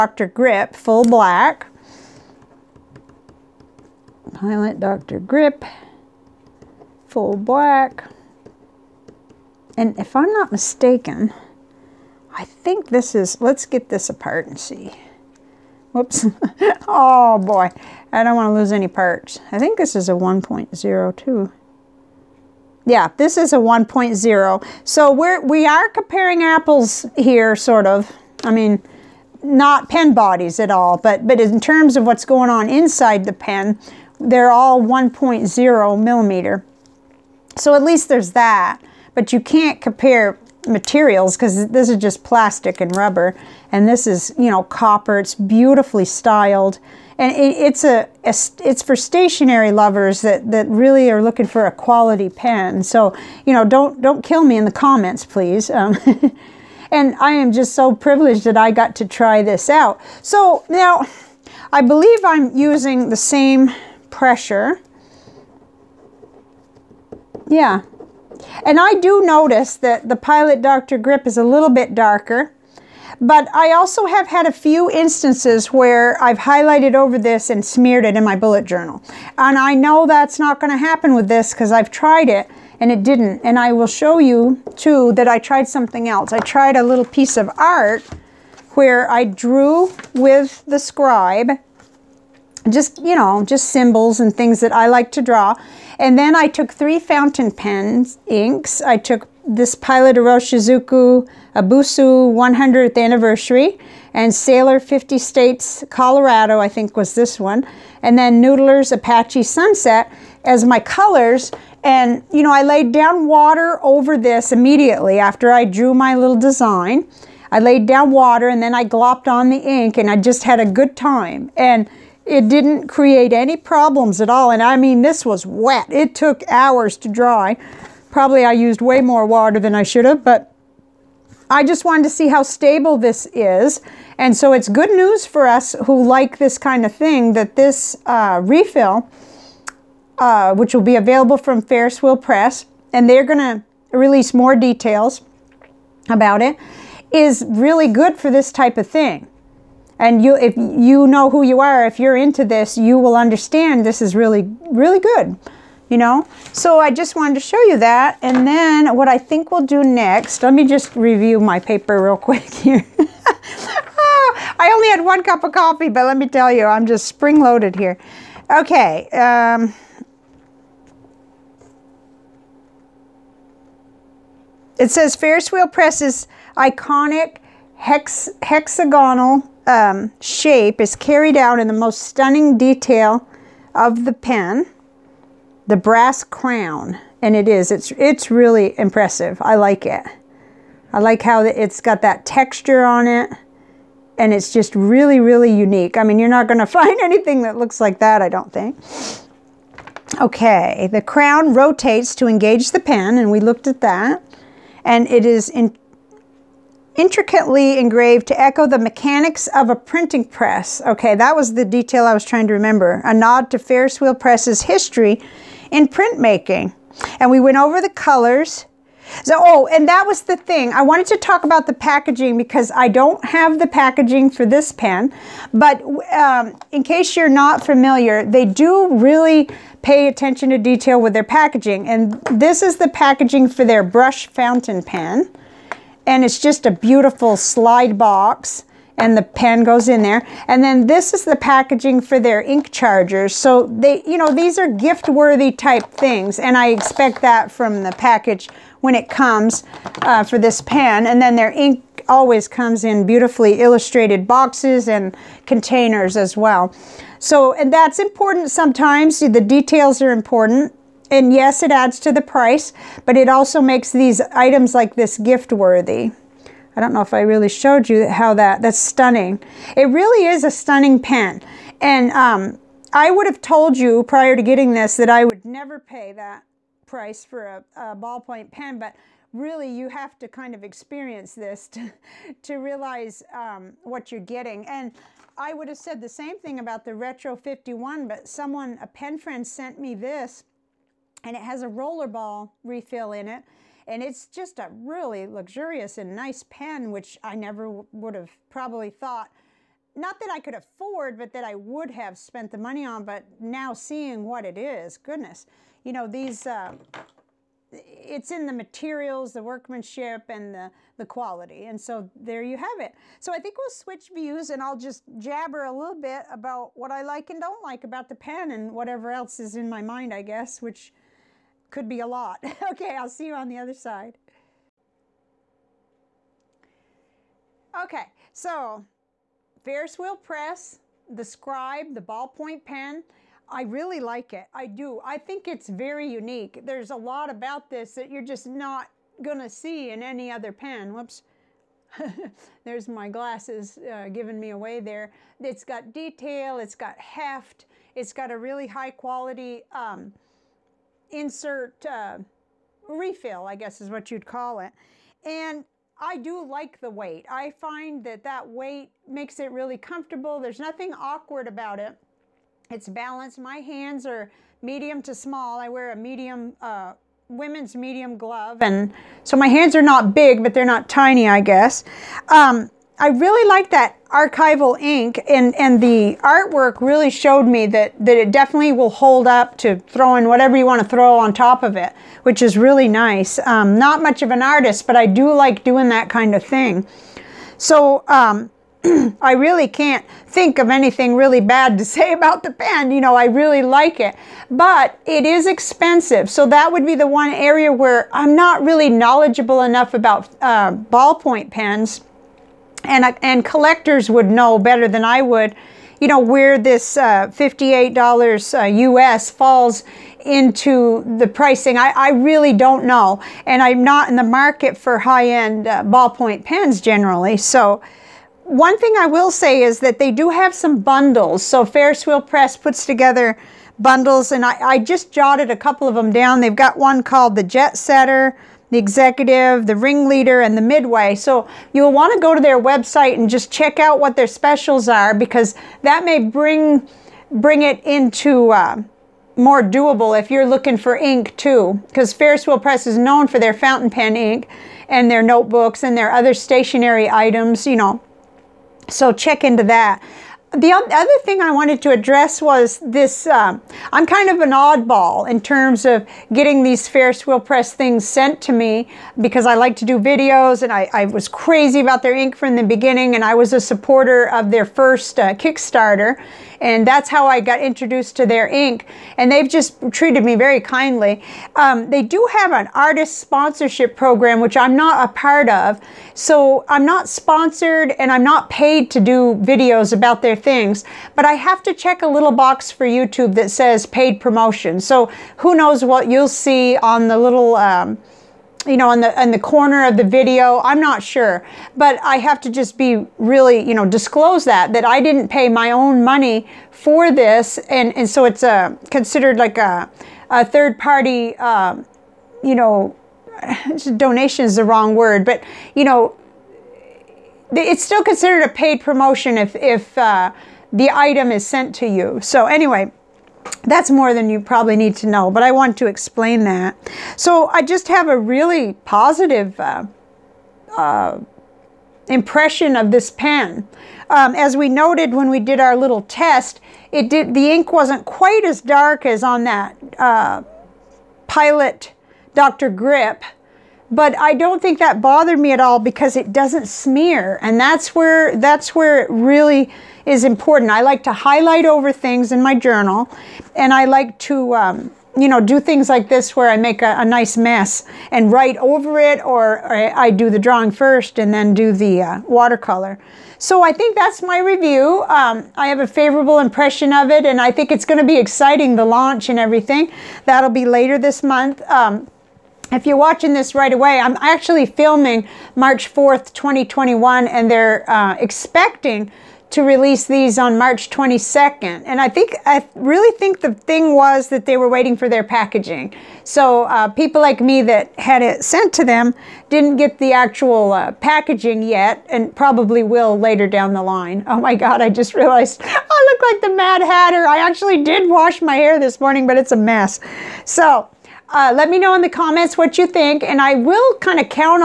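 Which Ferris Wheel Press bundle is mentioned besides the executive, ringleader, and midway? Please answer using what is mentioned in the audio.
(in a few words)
Jet Setter.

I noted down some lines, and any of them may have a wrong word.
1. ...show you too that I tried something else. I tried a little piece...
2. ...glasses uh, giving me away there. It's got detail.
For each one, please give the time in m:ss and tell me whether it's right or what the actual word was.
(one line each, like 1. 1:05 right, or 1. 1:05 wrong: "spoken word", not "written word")
1. 1:23 right
2. 5:43 right.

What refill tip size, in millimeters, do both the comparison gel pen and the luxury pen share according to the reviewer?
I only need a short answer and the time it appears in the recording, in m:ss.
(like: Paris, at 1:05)
1.0 millimeter, at 0:34.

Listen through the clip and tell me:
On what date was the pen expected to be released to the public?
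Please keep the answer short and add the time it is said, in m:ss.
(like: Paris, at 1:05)
March 22, at 9:30.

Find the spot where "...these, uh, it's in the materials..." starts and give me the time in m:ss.
5:06.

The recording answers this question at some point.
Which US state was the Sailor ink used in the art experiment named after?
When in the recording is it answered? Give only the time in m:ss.
1:45.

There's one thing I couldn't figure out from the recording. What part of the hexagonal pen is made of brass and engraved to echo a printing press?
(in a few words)
The crown.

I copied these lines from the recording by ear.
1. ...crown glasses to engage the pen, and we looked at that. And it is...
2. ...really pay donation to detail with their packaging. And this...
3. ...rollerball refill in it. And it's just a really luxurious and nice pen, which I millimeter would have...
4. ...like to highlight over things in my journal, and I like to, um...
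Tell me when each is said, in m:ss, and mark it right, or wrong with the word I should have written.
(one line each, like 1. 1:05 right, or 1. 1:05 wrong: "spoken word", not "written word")
1. 3:21 wrong: "rotates", not "glasses"
2. 3:48 wrong: "attention", not "donation"
3. 4:51 wrong: "never", not "millimeter"
4. 9:00 right.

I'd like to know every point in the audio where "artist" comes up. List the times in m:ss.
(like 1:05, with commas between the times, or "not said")
6:24, 7:52.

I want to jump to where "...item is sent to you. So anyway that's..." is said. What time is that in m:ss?
8:30.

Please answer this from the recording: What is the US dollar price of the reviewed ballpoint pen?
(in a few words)
$58.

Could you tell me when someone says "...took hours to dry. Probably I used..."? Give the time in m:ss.
2:06.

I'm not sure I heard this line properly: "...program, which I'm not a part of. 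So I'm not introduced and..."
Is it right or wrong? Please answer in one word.
wrong.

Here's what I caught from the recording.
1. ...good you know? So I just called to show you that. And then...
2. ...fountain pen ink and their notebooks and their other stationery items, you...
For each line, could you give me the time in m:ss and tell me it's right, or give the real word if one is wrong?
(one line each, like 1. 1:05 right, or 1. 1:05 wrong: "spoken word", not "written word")
1. 2:34 wrong: "wanted", not "called"
2. 7:23 right.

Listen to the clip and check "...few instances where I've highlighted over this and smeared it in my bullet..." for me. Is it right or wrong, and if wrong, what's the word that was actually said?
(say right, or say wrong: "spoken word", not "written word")
right.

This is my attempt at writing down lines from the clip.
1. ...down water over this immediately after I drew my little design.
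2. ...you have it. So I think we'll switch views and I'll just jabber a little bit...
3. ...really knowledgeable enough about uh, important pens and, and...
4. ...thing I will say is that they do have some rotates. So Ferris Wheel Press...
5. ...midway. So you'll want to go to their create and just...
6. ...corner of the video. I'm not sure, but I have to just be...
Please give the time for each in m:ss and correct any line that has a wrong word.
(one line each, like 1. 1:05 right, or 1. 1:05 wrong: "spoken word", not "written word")
1. 1:52 right
2. 5:12 right
3. 6:38 wrong: "ballpoint", not "important"
4. 6:58 wrong: "bundles", not "rotates"
5. 7:10 wrong: "website", not "create"
6. 8:09 right.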